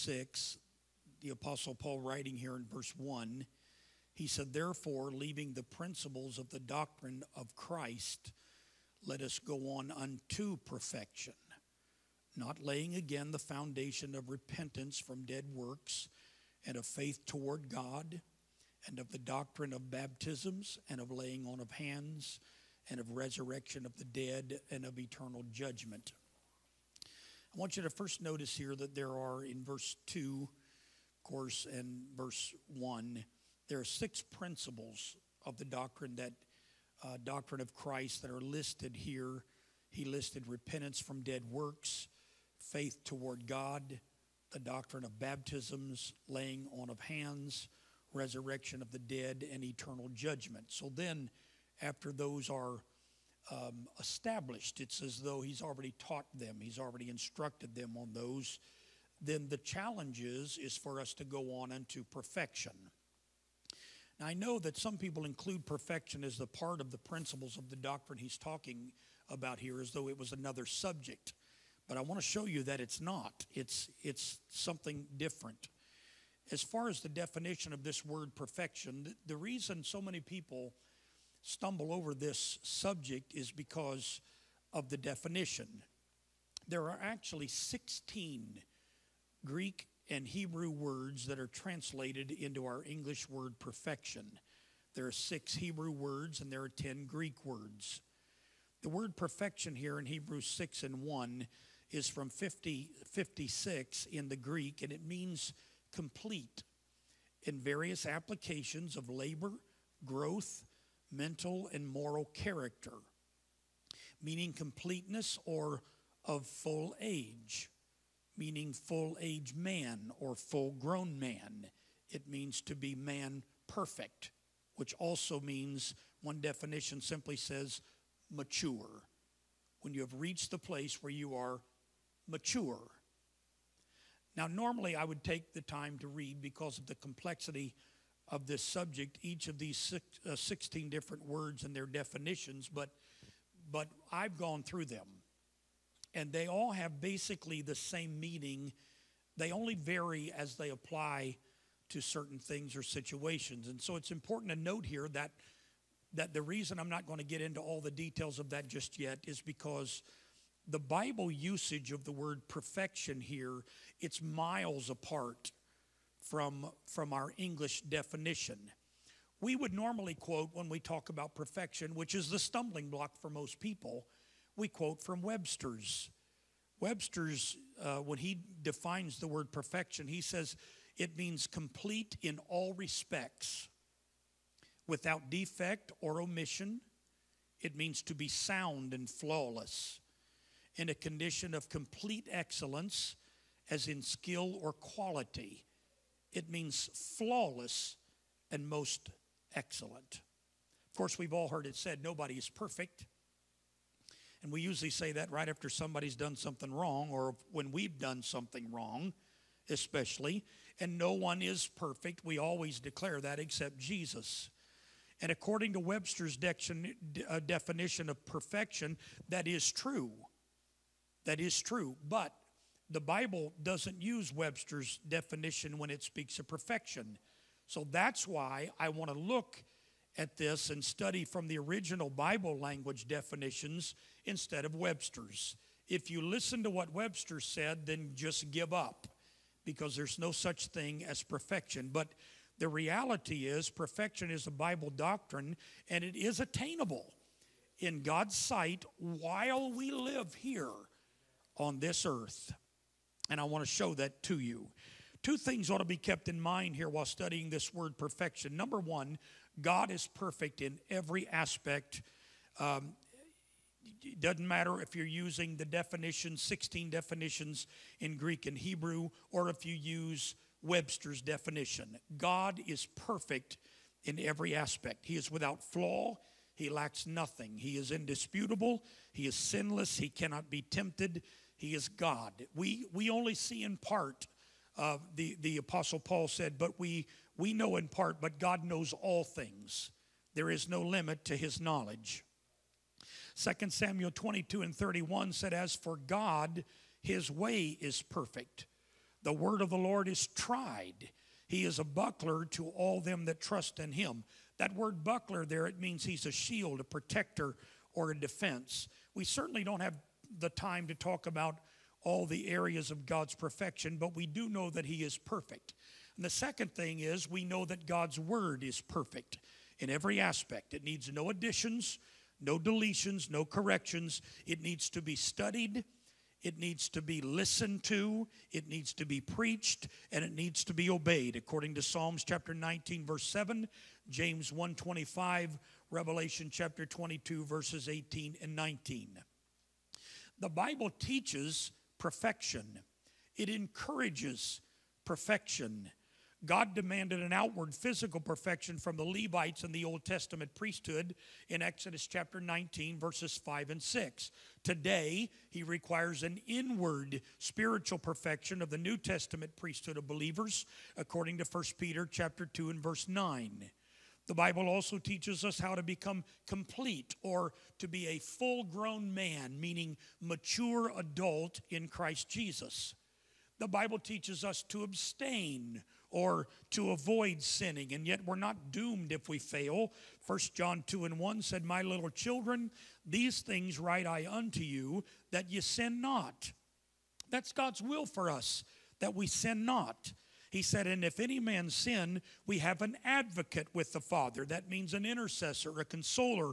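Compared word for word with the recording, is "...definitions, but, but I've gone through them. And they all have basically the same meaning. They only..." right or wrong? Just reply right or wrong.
right.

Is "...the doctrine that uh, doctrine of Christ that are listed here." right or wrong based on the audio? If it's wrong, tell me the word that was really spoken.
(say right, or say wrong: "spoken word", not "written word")
right.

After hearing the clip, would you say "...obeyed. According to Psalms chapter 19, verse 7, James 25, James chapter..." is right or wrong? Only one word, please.
wrong.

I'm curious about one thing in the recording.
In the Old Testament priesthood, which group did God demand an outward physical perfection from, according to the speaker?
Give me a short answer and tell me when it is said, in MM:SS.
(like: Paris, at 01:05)
the Levites, at 05:48.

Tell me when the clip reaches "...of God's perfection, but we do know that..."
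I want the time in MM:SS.
05:12.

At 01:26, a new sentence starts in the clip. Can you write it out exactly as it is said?
There are actually 16 Greek and Hebrew words that are translated into our English word perfection.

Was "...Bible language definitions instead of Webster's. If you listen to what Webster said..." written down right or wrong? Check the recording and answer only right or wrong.
right.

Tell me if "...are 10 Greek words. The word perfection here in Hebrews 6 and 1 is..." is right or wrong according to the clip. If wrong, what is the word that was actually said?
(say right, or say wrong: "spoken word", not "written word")
right.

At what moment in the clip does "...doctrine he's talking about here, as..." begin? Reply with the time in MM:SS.
01:07.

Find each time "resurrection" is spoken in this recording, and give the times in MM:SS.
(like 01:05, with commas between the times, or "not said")
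00:23, 00:48.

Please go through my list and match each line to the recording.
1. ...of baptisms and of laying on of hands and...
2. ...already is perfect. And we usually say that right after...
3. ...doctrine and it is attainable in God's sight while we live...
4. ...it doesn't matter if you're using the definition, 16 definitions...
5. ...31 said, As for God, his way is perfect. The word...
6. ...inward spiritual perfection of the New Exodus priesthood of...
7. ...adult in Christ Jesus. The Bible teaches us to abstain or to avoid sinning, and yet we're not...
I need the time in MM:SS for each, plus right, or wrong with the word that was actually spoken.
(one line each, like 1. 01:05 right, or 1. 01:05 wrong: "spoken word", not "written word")
1. 00:19 right
2. 03:22 wrong: "nobody", not "already"
3. 04:04 right
4. 04:24 right
5. 04:54 right
6. 05:56 wrong: "Testament", not "Exodus"
7. 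06:10 right.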